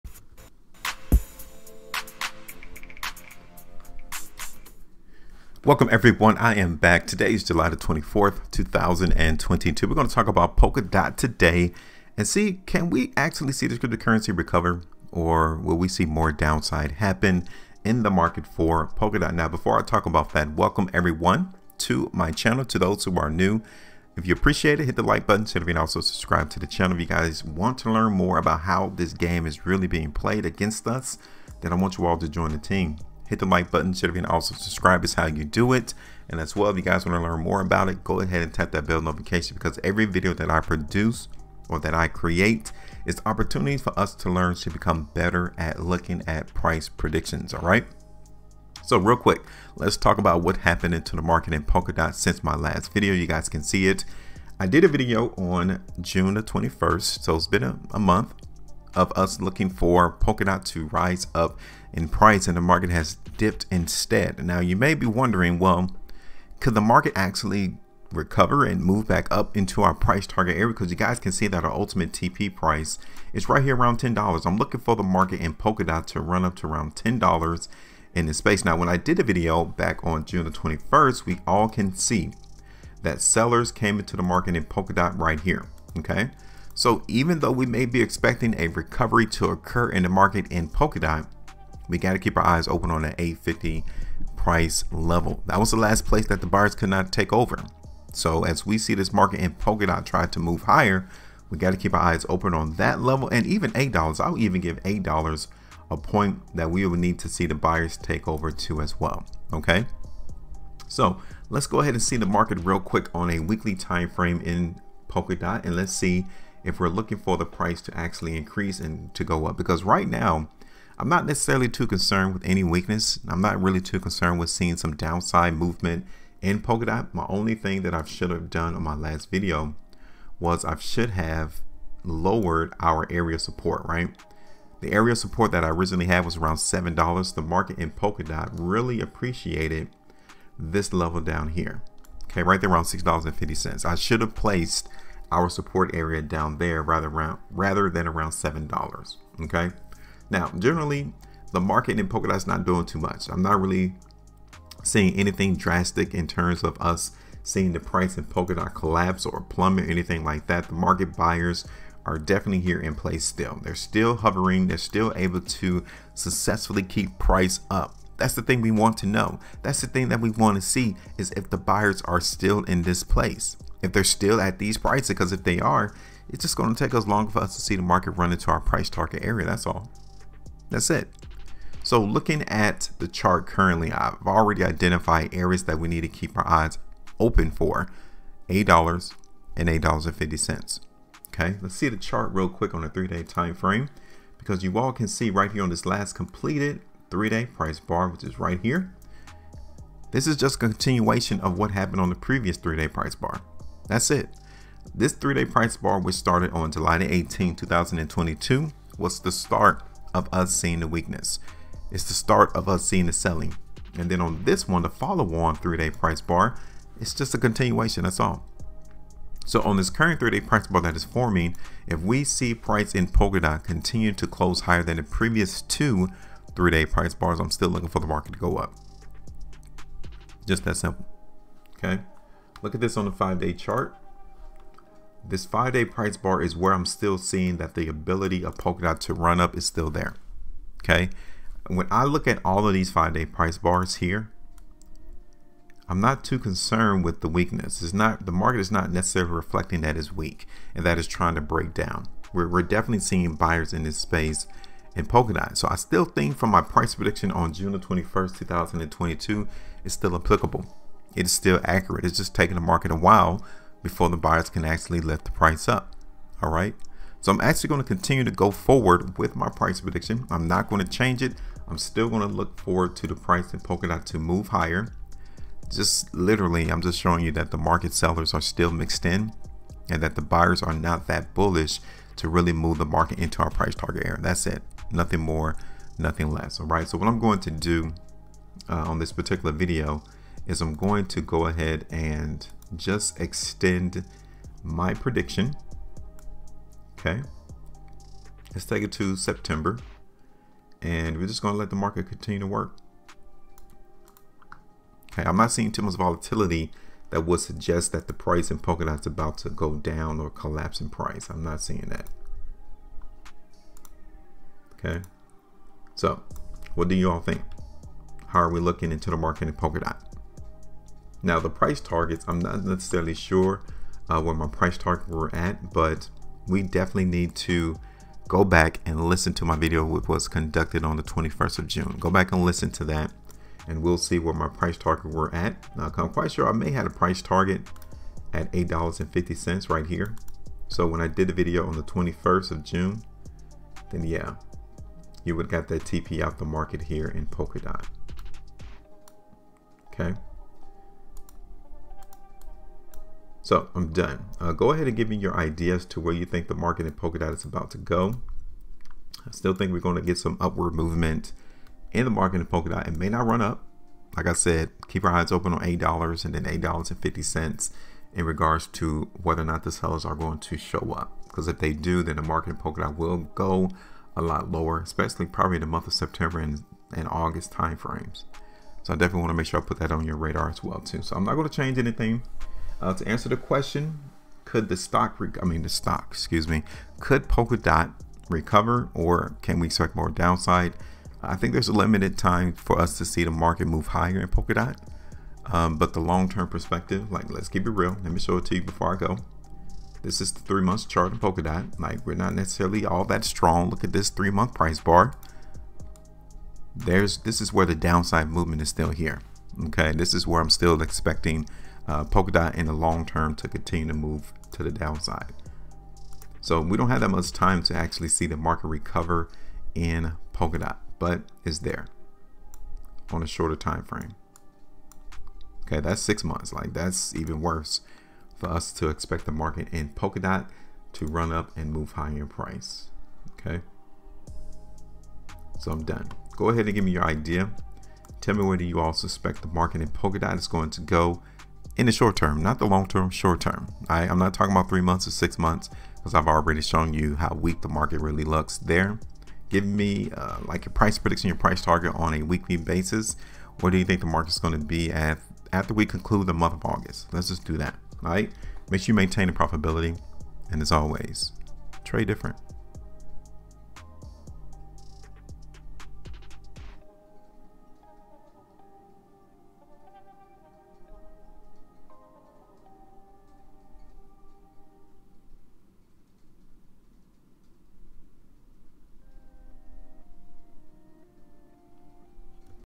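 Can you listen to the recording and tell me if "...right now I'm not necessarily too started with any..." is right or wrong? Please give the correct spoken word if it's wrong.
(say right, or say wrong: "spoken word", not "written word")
wrong: "concerned", not "started".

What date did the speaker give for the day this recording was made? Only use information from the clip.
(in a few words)
July 24, 2022.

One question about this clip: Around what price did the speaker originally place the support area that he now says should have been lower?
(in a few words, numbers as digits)
$7.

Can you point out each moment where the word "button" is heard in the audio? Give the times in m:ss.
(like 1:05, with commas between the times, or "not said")
0:25, 0:33.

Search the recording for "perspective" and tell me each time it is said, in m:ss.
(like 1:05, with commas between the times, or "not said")
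6:36.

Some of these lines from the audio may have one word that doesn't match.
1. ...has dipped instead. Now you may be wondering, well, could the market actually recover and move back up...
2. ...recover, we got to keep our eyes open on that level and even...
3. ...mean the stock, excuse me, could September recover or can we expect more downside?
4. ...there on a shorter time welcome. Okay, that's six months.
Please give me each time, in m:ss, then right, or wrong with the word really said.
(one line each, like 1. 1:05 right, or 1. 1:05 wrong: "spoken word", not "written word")
1. 1:02 right
2. 1:40 wrong: "higher", not "recover"
3. 6:25 wrong: "Polkadot", not "September"
4. 7:01 wrong: "frame", not "welcome".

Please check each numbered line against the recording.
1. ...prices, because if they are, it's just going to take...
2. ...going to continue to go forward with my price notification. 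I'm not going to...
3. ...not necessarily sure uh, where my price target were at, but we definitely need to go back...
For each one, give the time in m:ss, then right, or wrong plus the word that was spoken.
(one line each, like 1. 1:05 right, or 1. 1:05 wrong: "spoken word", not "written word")
1. 2:54 right
2. 4:27 wrong: "prediction", not "notification"
3. 5:22 right.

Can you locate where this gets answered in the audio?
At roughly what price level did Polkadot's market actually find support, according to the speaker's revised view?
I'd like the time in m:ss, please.
2:22.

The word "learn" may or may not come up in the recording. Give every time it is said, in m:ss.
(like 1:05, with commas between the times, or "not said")
0:27, 0:37, 0:44.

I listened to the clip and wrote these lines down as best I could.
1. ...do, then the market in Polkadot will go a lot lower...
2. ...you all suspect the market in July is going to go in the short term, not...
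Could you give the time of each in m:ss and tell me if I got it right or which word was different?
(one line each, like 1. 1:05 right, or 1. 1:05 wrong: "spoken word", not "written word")
1. 6:11 right
2. 7:18 wrong: "Polkadot", not "July".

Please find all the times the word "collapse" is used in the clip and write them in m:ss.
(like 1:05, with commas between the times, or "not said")
2:38, 5:10.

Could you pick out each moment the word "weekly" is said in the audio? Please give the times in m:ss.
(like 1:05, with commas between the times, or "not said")
1:53, 7:32.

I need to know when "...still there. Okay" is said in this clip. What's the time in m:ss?
3:59.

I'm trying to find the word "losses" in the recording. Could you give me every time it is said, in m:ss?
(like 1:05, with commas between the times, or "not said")
not said.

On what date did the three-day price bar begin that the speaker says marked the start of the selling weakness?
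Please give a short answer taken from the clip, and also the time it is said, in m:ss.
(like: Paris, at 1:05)
July 18, 2022, at 3:26.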